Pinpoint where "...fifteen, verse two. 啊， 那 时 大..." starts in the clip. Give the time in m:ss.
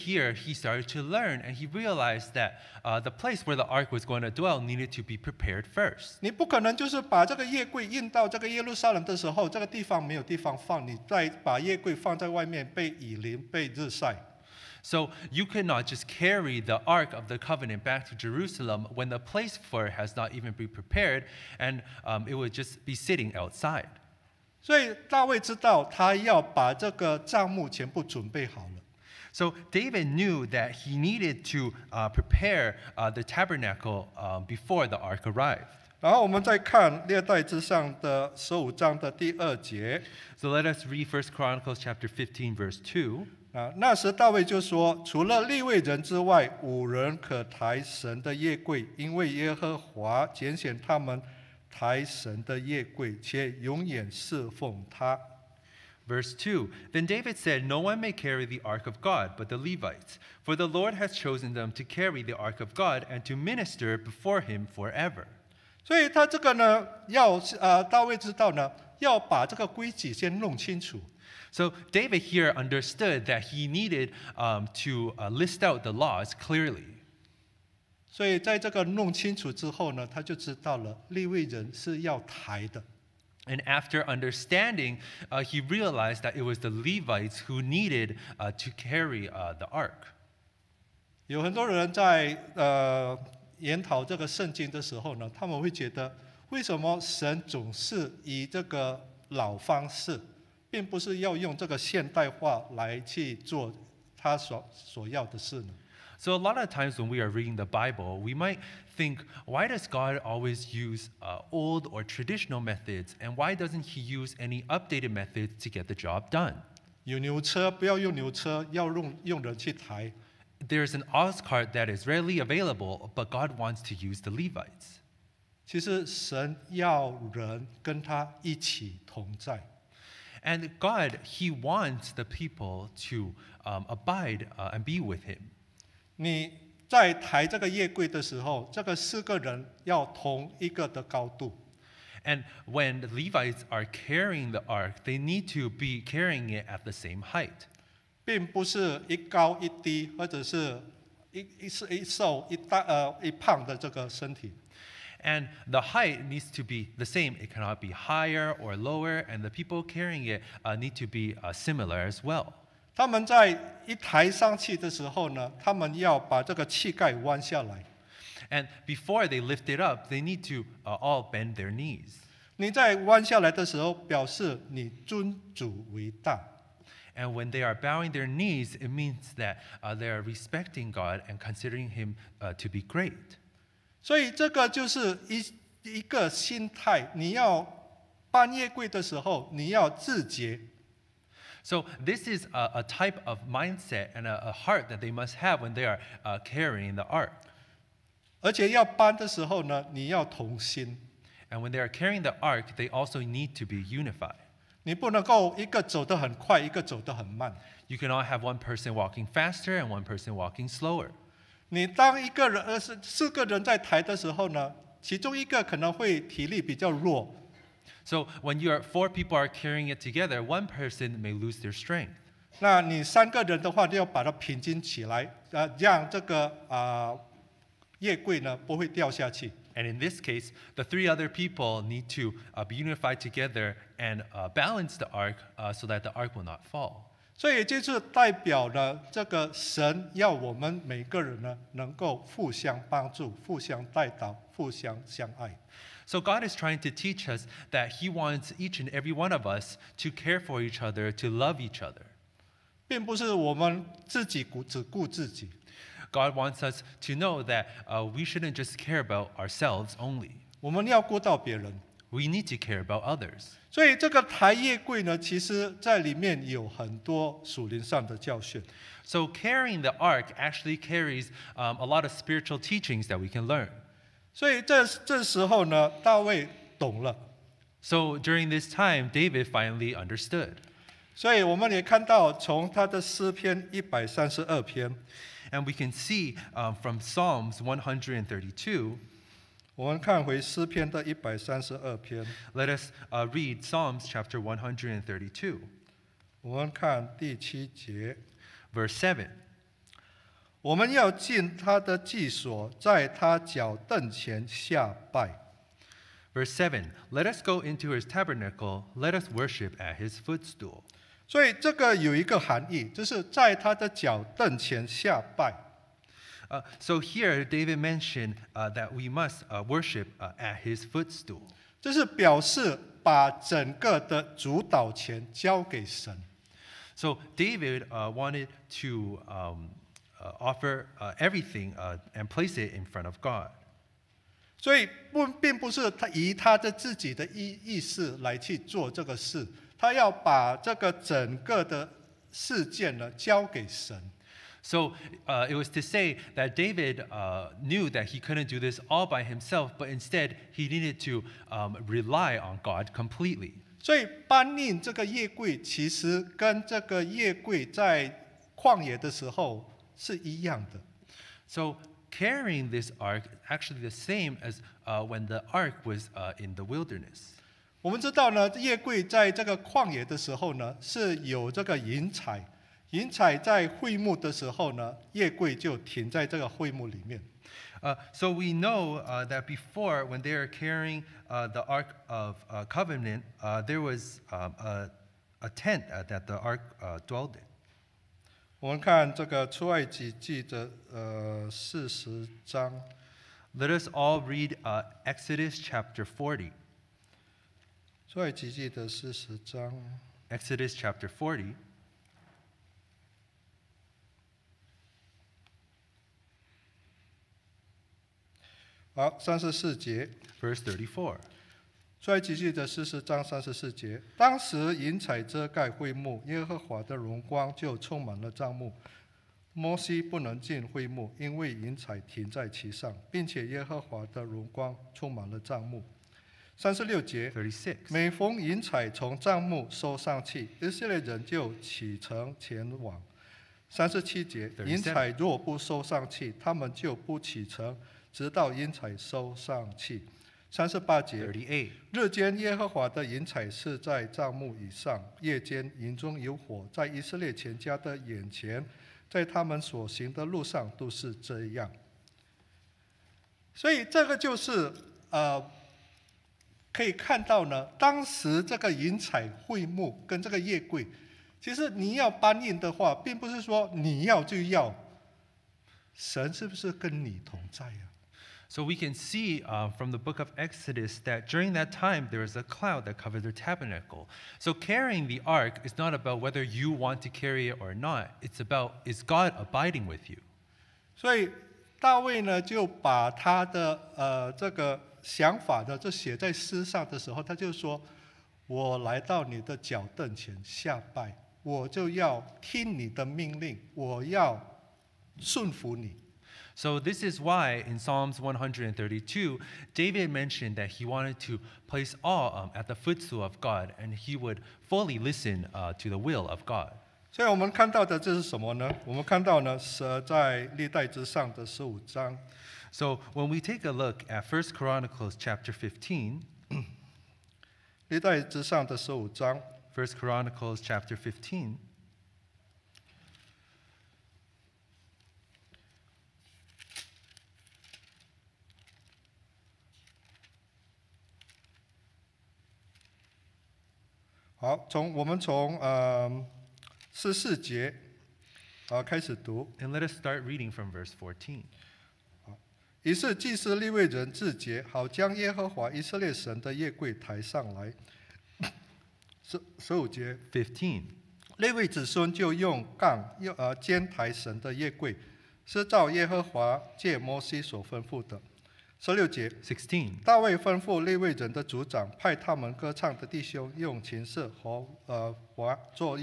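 0:42.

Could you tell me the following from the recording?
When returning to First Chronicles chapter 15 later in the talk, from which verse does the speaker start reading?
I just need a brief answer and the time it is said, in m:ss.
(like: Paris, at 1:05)
14, at 9:00.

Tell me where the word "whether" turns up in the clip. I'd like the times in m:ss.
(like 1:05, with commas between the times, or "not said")
7:56.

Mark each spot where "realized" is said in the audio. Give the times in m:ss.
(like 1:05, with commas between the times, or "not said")
0:01, 1:25.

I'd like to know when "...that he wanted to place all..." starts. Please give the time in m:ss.
8:20.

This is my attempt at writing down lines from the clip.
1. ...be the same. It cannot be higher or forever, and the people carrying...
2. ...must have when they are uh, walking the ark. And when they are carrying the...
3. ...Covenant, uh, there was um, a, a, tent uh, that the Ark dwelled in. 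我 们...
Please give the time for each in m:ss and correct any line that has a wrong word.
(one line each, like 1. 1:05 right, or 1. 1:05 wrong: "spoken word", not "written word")
1. 2:36 wrong: "lower", not "forever"
2. 3:15 wrong: "carrying", not "walking"
3. 6:22 right.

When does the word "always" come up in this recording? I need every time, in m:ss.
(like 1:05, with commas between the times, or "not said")
1:50.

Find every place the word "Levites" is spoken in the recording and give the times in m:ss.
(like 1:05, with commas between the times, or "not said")
0:59, 1:26, 2:04, 2:23.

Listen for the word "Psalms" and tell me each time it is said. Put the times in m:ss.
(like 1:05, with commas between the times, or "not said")
4:46, 4:53, 8:17.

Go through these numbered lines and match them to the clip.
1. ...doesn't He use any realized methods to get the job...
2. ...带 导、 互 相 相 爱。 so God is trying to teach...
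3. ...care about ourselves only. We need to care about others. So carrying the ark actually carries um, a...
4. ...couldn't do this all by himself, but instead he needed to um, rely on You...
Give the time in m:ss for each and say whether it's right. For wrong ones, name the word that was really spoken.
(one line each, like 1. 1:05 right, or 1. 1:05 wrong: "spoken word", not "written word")
1. 1:53 wrong: "updated", not "realized"
2. 4:03 right
3. 4:18 right
4. 5:48 wrong: "God", not "You".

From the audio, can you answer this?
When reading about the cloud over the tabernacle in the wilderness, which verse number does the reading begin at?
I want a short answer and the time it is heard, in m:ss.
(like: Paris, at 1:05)
34, at 6:50.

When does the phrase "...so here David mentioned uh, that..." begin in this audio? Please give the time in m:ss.
5:16.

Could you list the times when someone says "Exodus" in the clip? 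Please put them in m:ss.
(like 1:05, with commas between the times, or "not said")
6:35, 6:40, 7:50.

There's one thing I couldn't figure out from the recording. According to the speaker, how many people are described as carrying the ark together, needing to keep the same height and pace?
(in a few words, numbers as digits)
4.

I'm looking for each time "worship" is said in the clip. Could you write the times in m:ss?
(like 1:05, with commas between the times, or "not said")
5:09, 5:19.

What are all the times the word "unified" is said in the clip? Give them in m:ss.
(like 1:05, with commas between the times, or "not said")
3:23, 3:52.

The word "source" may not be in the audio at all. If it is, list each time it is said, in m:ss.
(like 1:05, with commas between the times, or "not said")
not said.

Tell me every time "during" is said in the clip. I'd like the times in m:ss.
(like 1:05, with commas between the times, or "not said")
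4:38, 7:51.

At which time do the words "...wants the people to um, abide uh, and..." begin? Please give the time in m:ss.
2:11.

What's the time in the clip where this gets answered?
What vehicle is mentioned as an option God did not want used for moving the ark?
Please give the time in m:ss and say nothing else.
2:01.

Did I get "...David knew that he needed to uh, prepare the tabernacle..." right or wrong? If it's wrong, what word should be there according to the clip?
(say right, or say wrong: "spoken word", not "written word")
right.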